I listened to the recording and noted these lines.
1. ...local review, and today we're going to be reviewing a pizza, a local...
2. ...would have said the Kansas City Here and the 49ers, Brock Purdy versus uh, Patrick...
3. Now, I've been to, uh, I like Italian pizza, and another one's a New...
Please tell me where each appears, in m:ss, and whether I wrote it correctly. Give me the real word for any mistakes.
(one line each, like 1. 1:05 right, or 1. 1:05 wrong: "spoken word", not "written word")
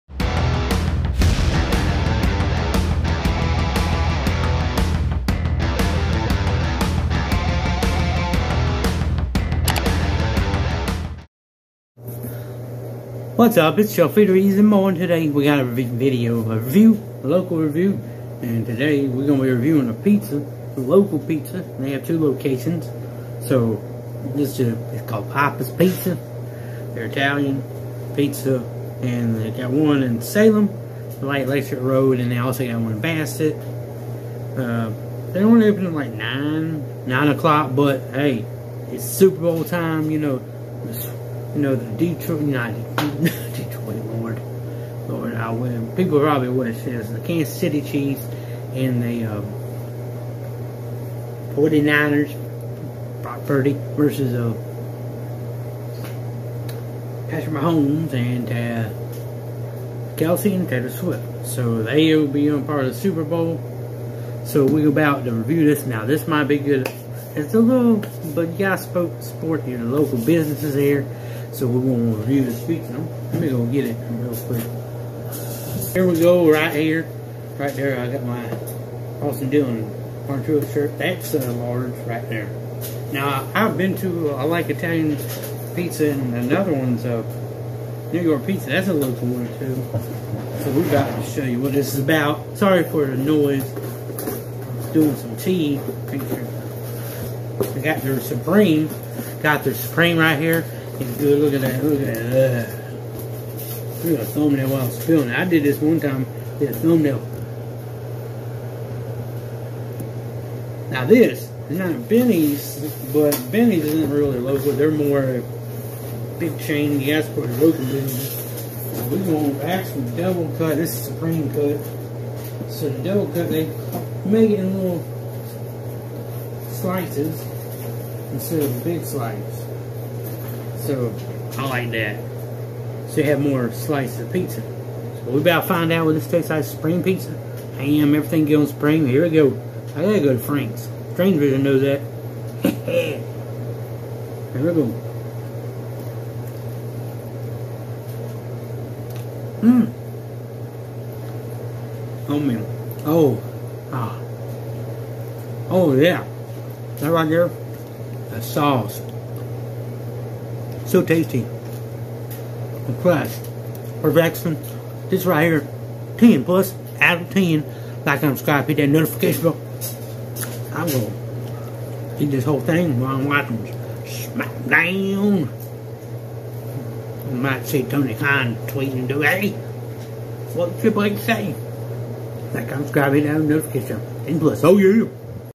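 1. 0:17 right
2. 0:46 wrong: "Chiefs", not "Here"
3. 1:23 right.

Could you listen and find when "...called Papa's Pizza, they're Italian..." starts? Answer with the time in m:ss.
0:25.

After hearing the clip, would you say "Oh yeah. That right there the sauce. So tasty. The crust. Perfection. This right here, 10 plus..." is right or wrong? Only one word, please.
right.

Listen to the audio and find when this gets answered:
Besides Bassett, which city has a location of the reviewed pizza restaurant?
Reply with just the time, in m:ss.
0:30.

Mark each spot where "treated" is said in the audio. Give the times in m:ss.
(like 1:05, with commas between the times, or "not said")
not said.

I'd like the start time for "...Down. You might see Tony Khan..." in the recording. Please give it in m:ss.
2:54.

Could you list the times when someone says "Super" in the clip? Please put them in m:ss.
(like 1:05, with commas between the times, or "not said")
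0:39, 1:02.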